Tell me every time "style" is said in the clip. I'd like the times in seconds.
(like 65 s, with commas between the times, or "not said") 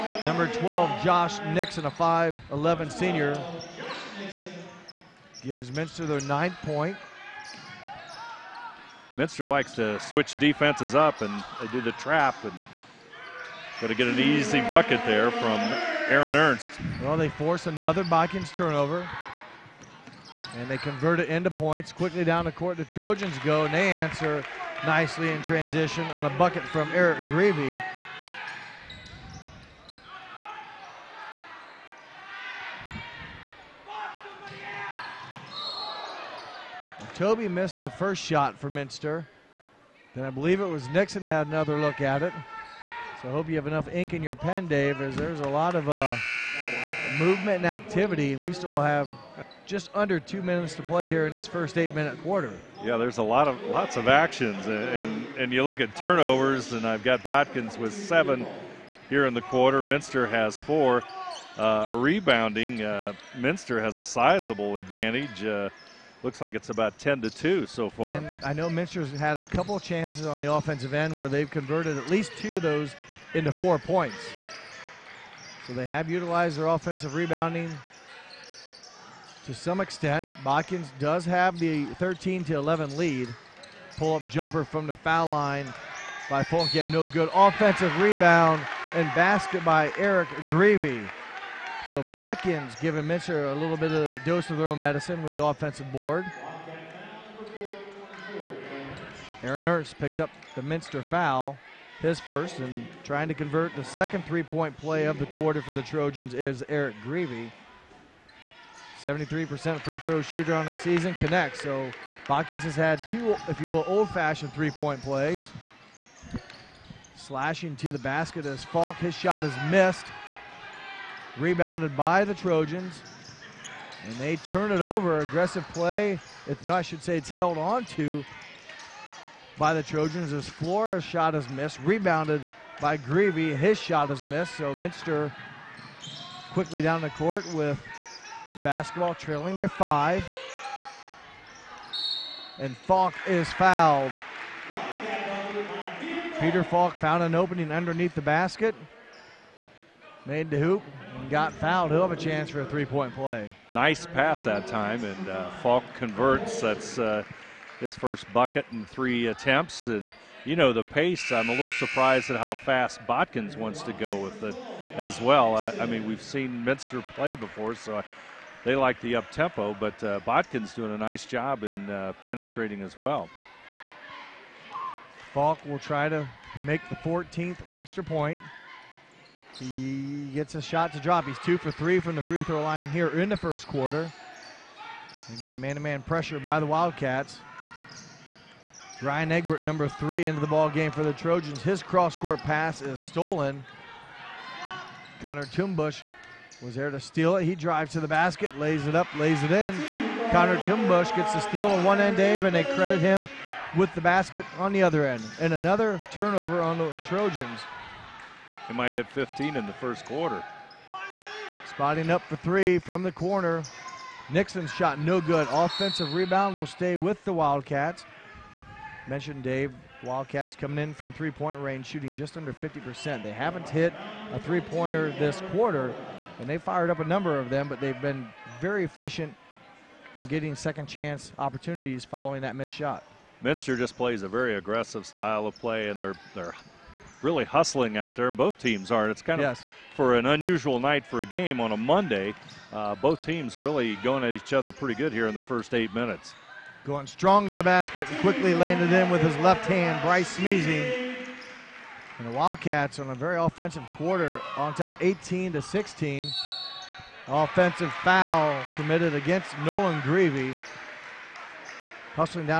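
235 s.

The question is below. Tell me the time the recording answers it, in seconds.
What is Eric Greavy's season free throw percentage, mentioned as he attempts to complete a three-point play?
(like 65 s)
109 s.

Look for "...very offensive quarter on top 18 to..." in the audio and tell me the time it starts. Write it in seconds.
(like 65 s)
253 s.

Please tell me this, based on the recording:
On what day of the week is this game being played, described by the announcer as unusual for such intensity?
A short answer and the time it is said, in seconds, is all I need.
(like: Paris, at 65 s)
Monday, at 241 s.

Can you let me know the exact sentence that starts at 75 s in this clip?
So they have utilized their offensive rebounding to some extent.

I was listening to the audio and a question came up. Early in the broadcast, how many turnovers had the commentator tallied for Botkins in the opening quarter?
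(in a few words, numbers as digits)
7.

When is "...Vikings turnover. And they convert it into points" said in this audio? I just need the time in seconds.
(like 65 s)
18 s.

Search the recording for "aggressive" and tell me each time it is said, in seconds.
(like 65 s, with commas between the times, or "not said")
125 s, 234 s.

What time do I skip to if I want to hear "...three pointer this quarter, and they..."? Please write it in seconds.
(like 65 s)
224 s.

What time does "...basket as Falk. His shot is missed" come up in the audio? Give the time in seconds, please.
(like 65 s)
117 s.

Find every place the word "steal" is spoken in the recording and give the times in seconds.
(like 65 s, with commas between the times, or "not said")
196 s, 201 s.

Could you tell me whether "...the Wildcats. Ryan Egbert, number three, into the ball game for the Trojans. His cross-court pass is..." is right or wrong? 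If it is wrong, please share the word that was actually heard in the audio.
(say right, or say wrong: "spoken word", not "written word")
right.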